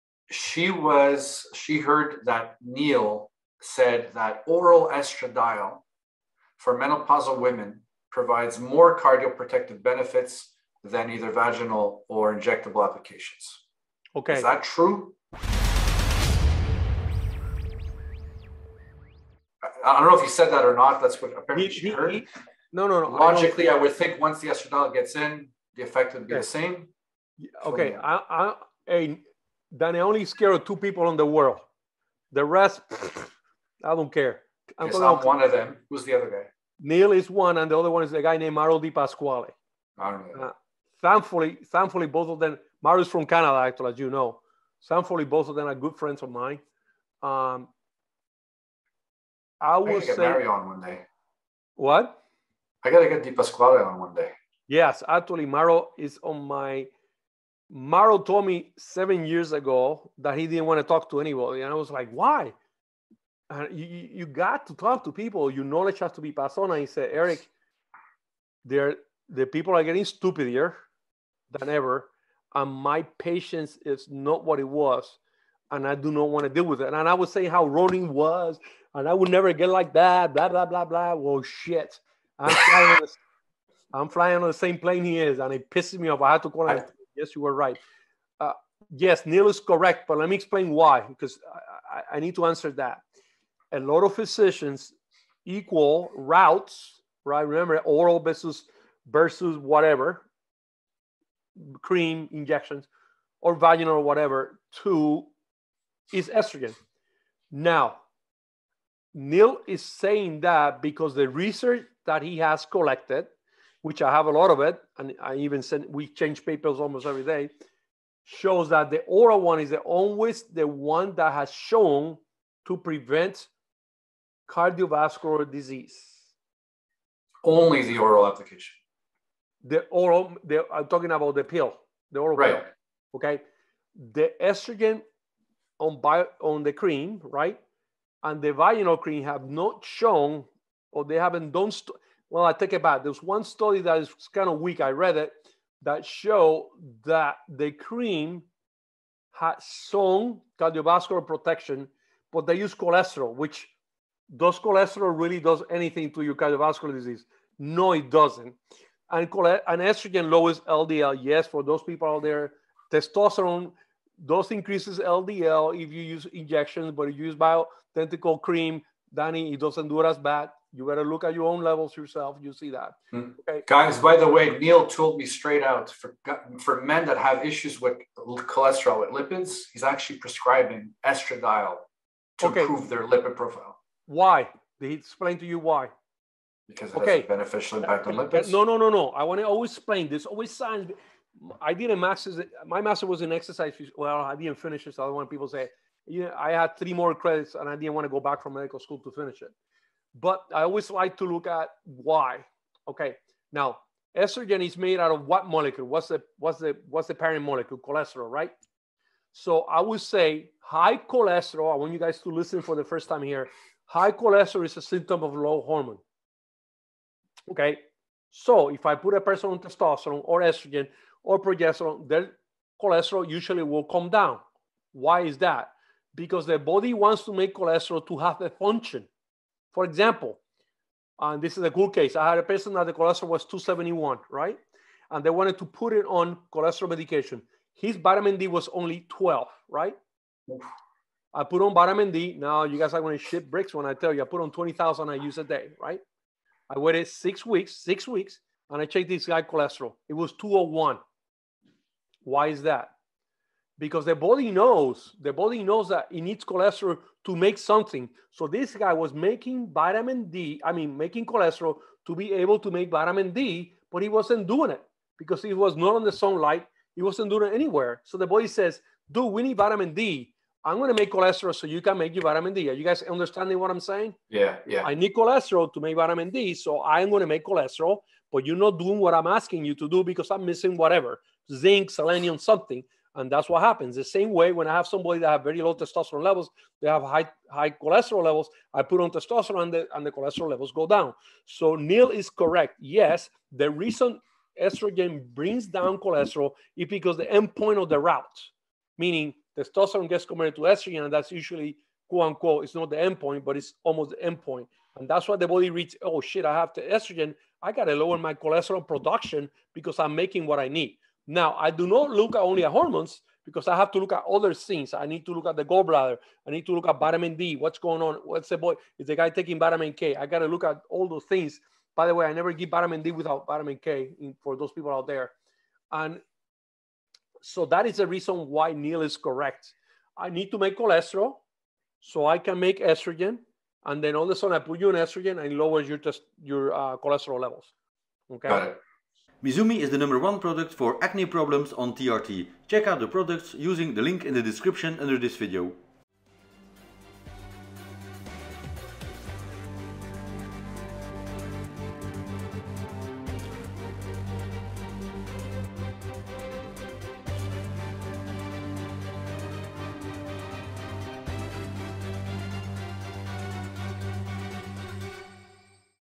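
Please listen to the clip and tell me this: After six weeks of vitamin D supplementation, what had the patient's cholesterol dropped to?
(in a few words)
201.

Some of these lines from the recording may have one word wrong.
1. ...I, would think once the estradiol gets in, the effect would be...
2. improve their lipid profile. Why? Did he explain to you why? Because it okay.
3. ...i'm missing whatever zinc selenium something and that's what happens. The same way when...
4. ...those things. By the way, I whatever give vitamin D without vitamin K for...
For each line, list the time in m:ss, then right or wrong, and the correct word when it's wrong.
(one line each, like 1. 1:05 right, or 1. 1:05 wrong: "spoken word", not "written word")
1. 0:23 right
2. 3:02 right
3. 4:40 right
4. 5:21 wrong: "never", not "whatever".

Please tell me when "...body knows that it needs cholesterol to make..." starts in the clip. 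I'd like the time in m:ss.
4:15.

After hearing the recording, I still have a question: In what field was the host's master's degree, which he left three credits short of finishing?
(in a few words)
Exercise.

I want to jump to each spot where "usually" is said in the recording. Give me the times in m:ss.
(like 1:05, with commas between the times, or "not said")
3:43, 5:01.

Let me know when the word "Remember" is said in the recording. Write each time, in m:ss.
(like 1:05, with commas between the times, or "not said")
1:37.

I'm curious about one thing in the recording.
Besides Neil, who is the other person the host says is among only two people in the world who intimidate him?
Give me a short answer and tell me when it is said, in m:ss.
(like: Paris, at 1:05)
Mario Di Pasquale, at 0:38.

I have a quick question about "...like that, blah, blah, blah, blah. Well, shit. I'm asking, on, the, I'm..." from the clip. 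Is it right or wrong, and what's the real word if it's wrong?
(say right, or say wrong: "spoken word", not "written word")
wrong: "flying", not "asking".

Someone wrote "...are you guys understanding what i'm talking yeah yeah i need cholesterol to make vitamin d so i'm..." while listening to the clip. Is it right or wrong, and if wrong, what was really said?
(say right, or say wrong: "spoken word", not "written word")
wrong: "saying", not "talking".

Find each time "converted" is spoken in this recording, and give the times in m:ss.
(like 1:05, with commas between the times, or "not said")
5:00.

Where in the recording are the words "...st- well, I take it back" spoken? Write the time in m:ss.
2:21.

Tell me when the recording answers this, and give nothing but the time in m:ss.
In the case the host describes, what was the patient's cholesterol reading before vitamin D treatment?
3:53.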